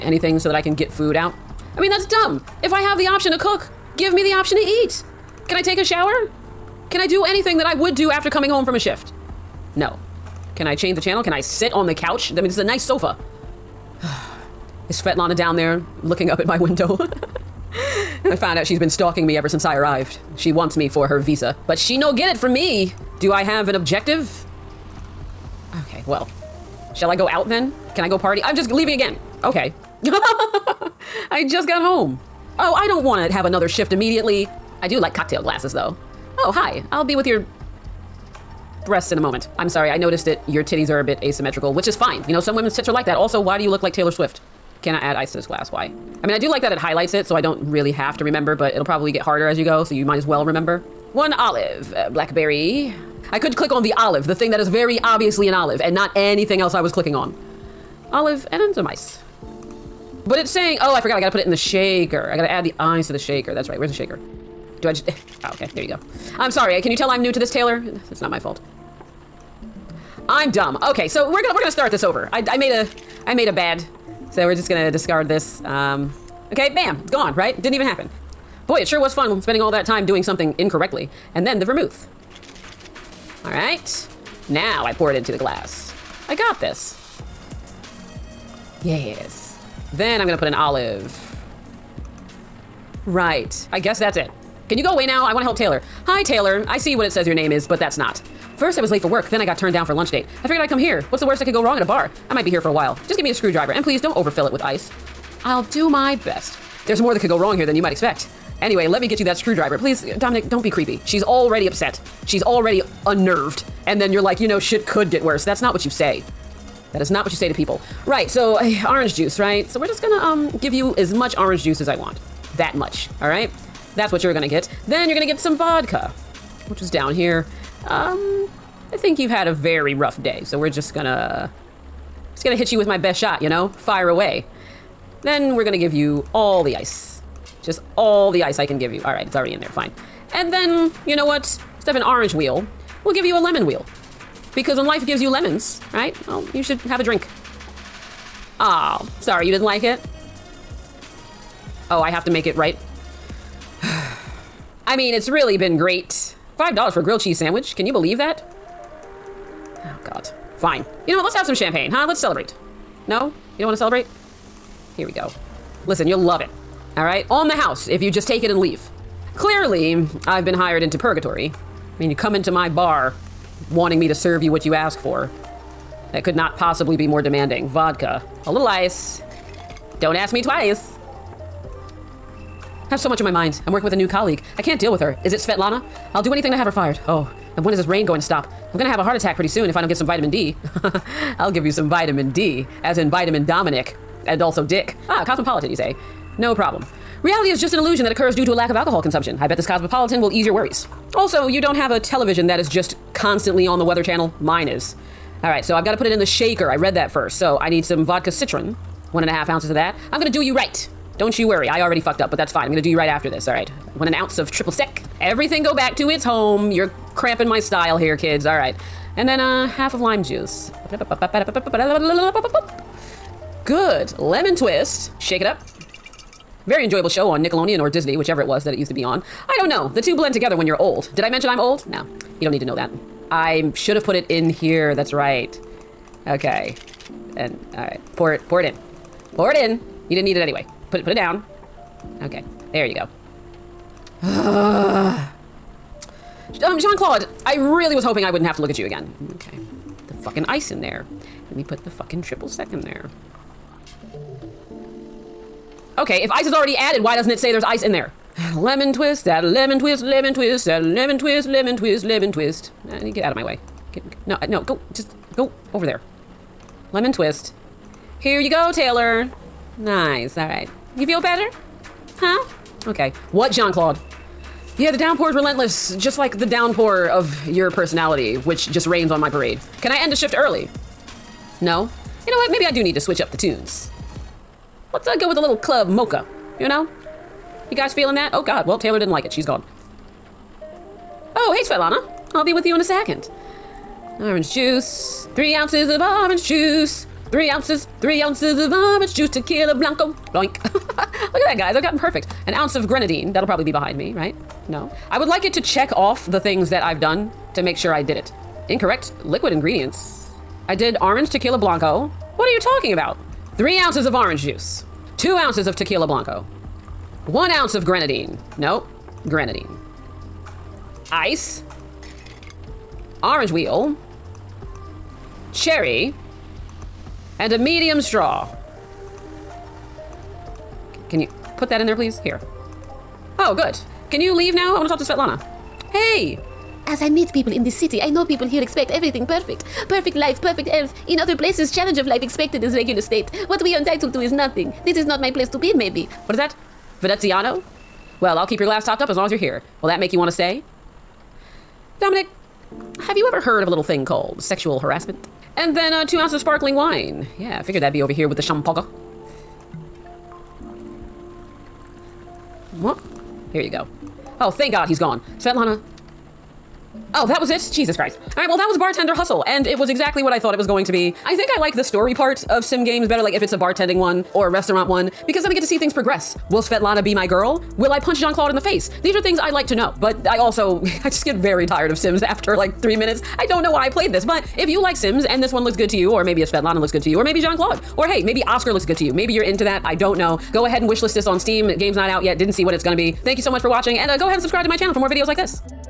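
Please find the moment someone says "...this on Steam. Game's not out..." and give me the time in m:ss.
6:31.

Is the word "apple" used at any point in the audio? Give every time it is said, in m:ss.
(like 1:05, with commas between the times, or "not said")
not said.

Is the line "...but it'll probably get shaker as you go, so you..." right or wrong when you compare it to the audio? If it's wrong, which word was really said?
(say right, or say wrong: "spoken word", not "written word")
wrong: "harder", not "shaker".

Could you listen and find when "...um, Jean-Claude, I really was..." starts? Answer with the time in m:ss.
4:04.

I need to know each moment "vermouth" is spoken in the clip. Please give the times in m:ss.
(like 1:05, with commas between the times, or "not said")
1:21.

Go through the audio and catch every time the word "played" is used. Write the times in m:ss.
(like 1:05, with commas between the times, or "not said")
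6:23.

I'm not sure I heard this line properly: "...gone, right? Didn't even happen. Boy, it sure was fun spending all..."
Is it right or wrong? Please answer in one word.
right.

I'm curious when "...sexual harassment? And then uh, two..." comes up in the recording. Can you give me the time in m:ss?
5:54.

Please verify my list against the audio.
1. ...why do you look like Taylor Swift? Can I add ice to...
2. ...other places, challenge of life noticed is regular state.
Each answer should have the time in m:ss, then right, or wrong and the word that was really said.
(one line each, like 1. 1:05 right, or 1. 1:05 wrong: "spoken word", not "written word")
1. 0:43 right
2. 5:41 wrong: "expected", not "noticed".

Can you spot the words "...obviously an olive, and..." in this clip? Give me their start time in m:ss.
0:55.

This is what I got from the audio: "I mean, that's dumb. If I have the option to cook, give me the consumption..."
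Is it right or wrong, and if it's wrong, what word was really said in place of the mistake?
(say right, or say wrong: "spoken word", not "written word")
wrong: "option", not "consumption".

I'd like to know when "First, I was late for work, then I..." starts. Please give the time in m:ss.
1:38.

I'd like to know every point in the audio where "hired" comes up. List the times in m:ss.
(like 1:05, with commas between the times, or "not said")
2:50.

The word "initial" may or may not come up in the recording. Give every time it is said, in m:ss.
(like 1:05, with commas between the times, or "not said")
not said.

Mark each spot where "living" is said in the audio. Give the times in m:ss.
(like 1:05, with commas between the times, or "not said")
not said.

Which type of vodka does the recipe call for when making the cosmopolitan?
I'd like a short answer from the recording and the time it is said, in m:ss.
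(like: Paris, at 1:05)
Vodka citron, at 3:28.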